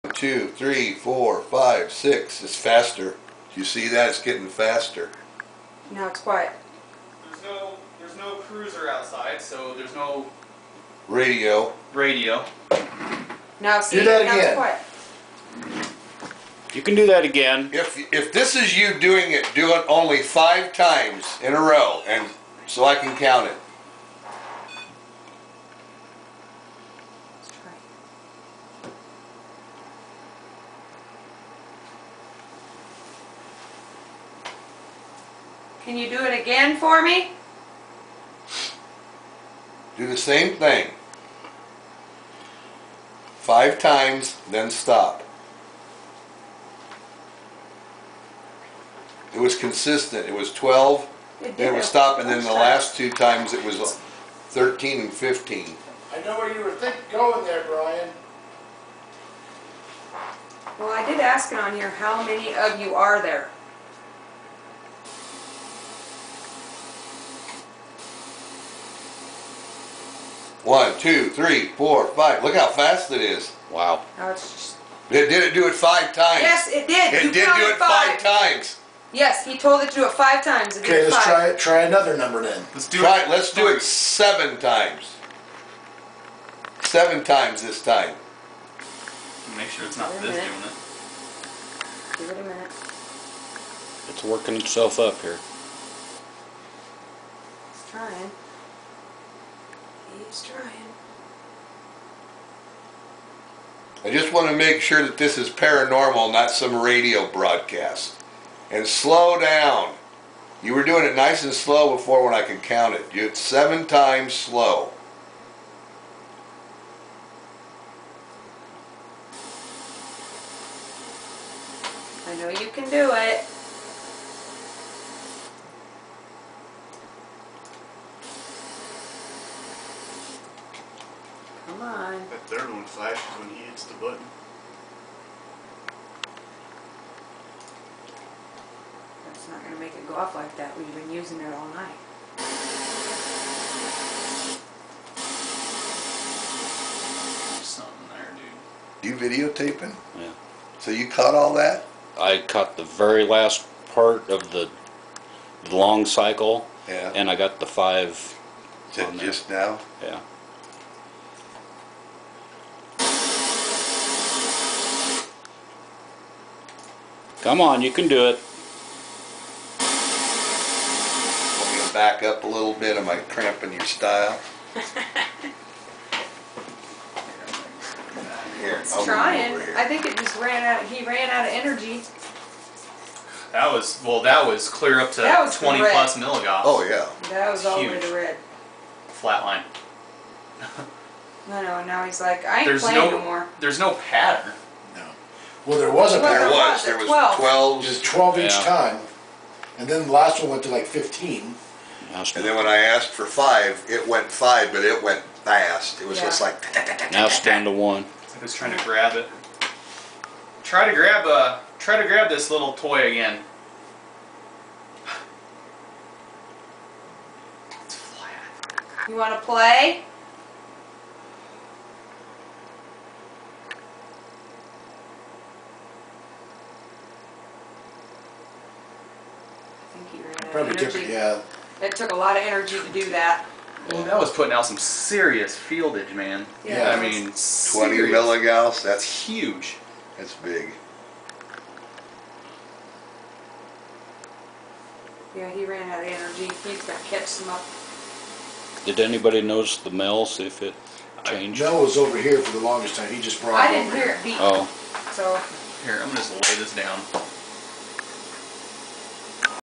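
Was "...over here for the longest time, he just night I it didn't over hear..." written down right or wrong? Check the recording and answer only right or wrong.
wrong.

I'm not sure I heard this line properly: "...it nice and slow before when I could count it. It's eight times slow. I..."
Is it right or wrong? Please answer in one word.
wrong.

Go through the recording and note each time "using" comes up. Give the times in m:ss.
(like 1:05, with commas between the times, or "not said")
2:21.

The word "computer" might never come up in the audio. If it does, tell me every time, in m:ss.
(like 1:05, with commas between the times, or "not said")
3:50.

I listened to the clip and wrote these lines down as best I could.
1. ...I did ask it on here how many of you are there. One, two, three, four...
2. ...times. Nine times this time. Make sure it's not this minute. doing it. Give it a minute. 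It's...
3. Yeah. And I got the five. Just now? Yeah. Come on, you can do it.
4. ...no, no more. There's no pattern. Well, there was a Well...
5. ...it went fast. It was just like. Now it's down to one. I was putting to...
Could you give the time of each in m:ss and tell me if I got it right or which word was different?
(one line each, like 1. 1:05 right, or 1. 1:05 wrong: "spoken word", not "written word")
1. 1:00 right
2. 1:24 wrong: "Seven", not "Nine"
3. 2:36 right
4. 3:12 right
5. 3:24 wrong: "trying", not "putting".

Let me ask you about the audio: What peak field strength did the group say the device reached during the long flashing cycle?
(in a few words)
20 plus milligauss.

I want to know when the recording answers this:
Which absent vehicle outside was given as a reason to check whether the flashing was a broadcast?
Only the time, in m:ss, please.
0:08.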